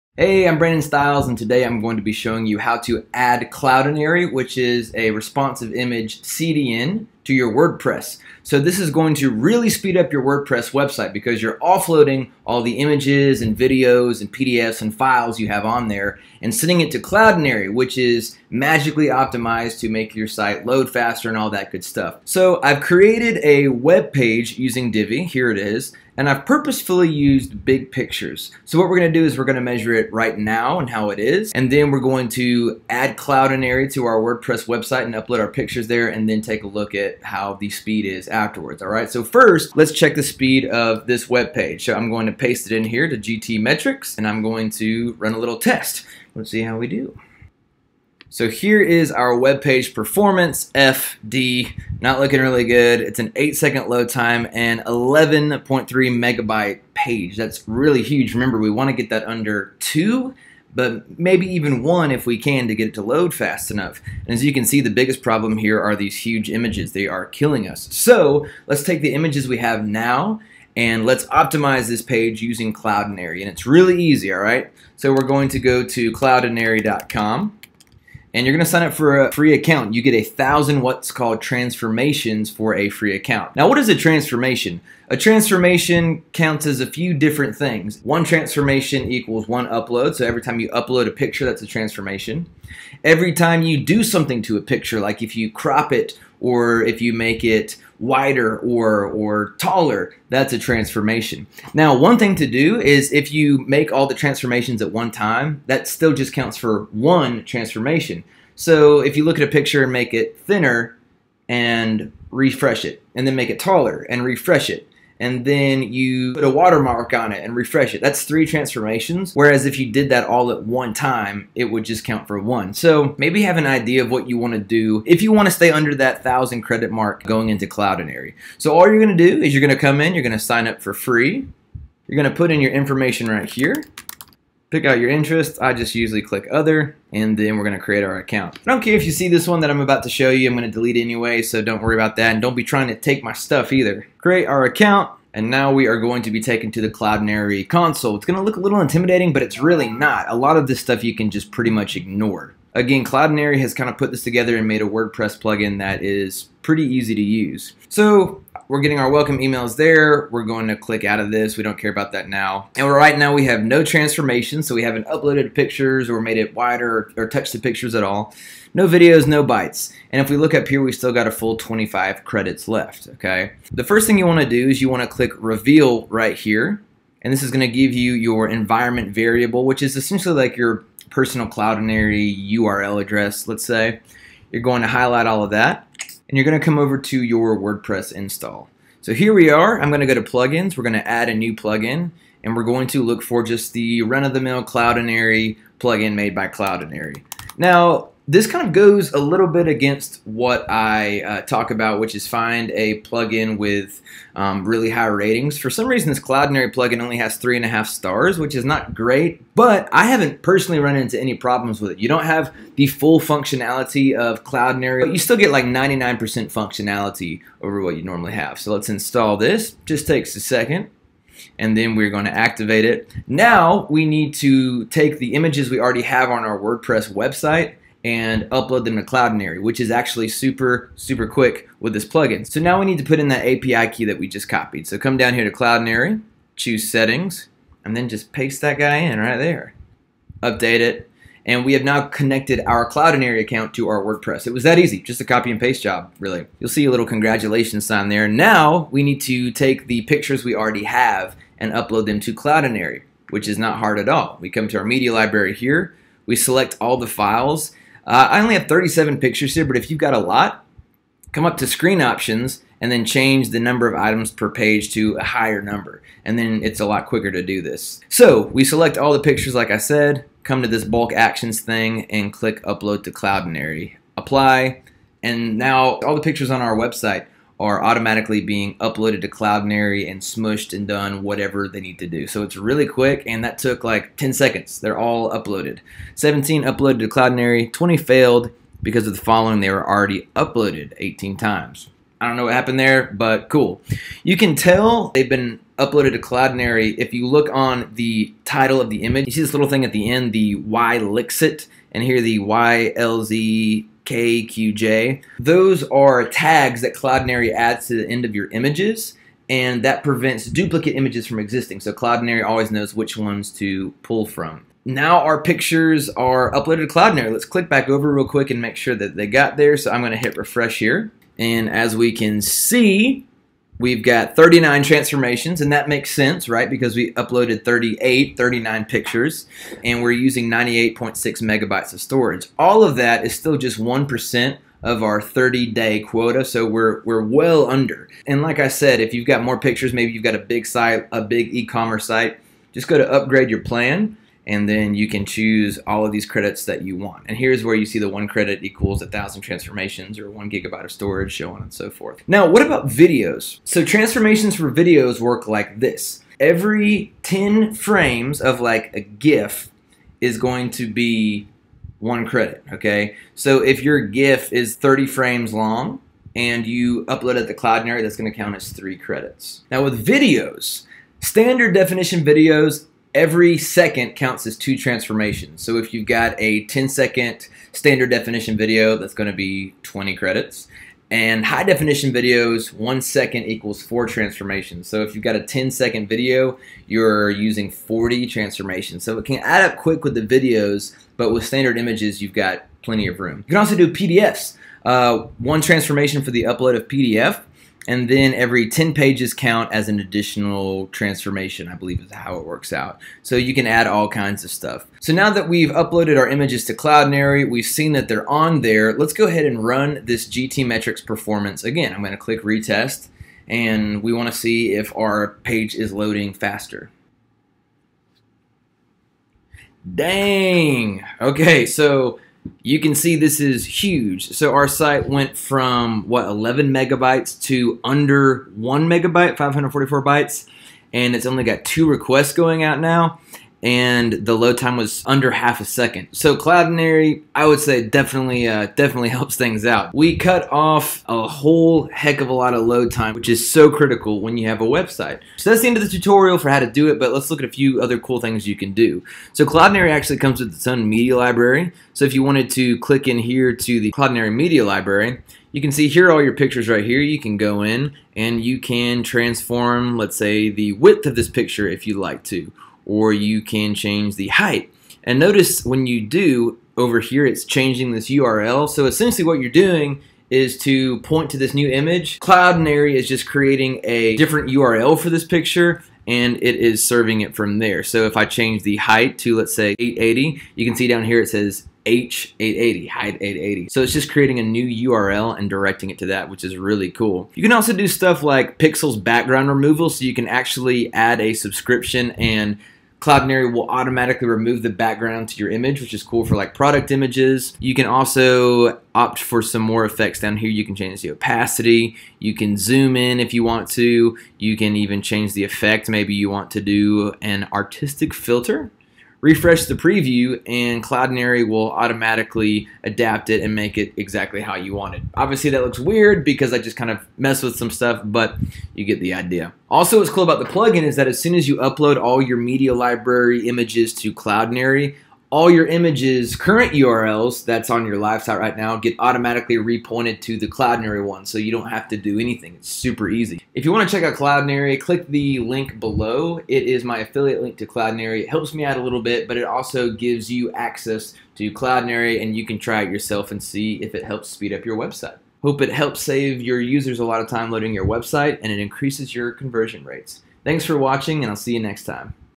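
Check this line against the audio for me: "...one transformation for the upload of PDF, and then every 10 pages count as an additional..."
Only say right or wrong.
right.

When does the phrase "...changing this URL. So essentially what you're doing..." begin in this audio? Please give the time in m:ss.
7:47.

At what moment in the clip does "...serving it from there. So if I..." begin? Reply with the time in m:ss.
7:56.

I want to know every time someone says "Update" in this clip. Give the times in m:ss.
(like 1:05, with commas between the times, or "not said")
4:00.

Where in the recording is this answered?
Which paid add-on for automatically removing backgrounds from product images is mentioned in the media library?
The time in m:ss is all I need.
8:08.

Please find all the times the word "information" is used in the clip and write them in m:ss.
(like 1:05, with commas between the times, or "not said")
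2:12.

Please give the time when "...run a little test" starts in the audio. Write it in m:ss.
0:45.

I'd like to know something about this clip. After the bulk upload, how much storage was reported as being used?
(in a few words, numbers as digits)
98.6 megabytes.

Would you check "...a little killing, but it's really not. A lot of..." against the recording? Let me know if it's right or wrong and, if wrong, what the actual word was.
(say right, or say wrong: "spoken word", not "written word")
wrong: "intimidating", not "killing".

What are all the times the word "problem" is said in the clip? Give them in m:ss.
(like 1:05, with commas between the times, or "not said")
1:05, 3:31.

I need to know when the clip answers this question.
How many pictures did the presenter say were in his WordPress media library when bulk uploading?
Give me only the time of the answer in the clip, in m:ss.
4:18.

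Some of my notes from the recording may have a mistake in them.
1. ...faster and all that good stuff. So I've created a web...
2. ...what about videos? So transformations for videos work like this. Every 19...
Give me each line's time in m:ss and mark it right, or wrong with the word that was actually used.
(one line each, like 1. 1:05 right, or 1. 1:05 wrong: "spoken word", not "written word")
1. 0:20 right
2. 5:52 wrong: "10", not "19".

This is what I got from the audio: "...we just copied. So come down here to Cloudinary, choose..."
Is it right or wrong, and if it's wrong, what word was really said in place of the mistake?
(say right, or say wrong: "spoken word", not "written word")
right.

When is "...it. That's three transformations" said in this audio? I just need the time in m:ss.
1:57.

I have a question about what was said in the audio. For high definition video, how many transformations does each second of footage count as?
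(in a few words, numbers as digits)
4.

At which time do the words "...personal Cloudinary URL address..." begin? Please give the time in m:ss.
3:01.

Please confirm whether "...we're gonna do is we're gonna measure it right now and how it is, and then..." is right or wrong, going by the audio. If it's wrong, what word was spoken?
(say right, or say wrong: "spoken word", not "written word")
right.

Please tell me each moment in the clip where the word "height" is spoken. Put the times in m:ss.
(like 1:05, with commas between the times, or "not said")
7:44, 7:58, 8:02.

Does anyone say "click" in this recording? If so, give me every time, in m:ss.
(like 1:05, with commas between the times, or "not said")
2:16, 2:40, 2:55, 4:32, 5:17, 6:52, 7:32, 8:54.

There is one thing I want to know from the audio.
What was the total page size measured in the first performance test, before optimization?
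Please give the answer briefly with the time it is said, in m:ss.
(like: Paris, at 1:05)
11.3 megabytes, at 0:54.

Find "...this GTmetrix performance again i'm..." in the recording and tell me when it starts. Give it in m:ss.
6:50.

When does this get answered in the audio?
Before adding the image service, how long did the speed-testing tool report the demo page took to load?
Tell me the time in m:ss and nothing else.
0:53.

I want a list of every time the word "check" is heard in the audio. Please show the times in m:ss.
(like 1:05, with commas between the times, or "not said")
0:39, 8:53.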